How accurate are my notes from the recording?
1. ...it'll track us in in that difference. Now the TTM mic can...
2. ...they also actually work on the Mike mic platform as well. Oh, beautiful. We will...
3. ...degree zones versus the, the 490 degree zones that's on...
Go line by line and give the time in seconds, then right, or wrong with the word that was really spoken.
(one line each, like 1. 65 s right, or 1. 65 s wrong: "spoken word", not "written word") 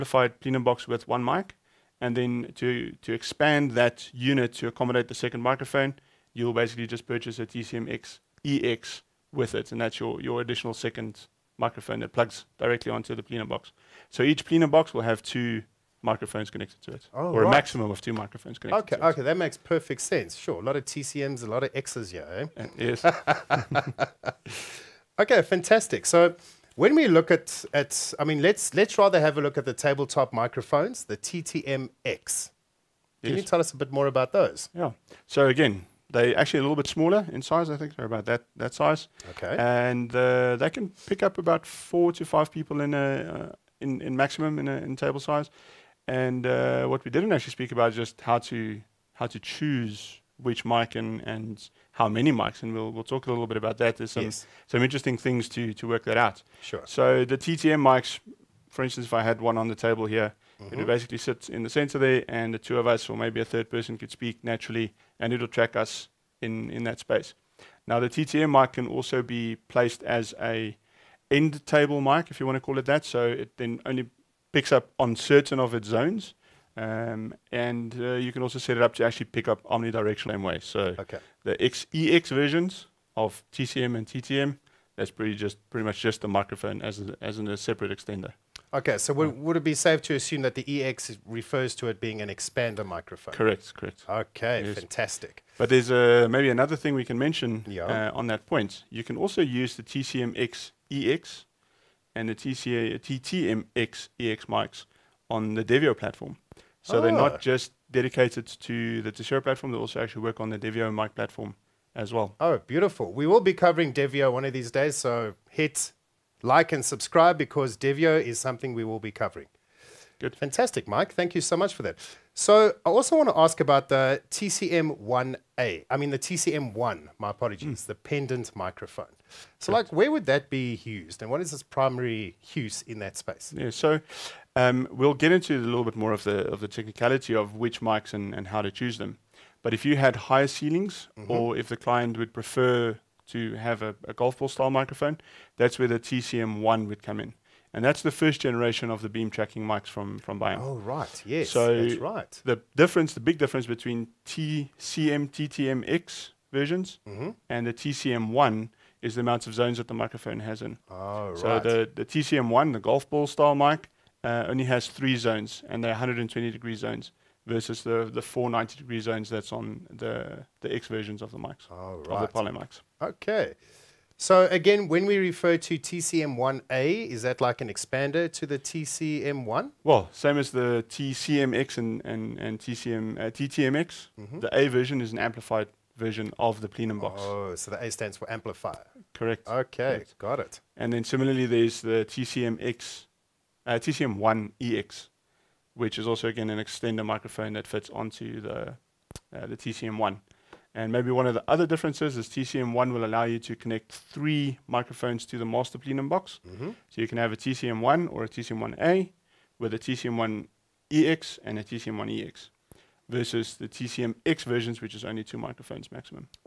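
1. 65 s wrong: "space", not "difference"
2. 109 s wrong: "Devio", not "Mike"
3. 166 s right.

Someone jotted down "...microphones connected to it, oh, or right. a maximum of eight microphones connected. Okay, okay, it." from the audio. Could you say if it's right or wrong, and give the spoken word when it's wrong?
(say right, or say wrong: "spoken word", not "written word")
wrong: "two", not "eight".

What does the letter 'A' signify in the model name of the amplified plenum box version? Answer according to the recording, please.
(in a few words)
Amplifier.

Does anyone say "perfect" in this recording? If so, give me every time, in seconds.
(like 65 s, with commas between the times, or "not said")
19 s.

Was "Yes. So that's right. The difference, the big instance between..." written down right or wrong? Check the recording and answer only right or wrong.
wrong.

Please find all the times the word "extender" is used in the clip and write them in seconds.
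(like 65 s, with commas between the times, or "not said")
87 s, 196 s.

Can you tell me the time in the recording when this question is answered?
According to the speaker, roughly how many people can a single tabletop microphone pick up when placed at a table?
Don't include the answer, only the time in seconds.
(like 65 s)
41 s.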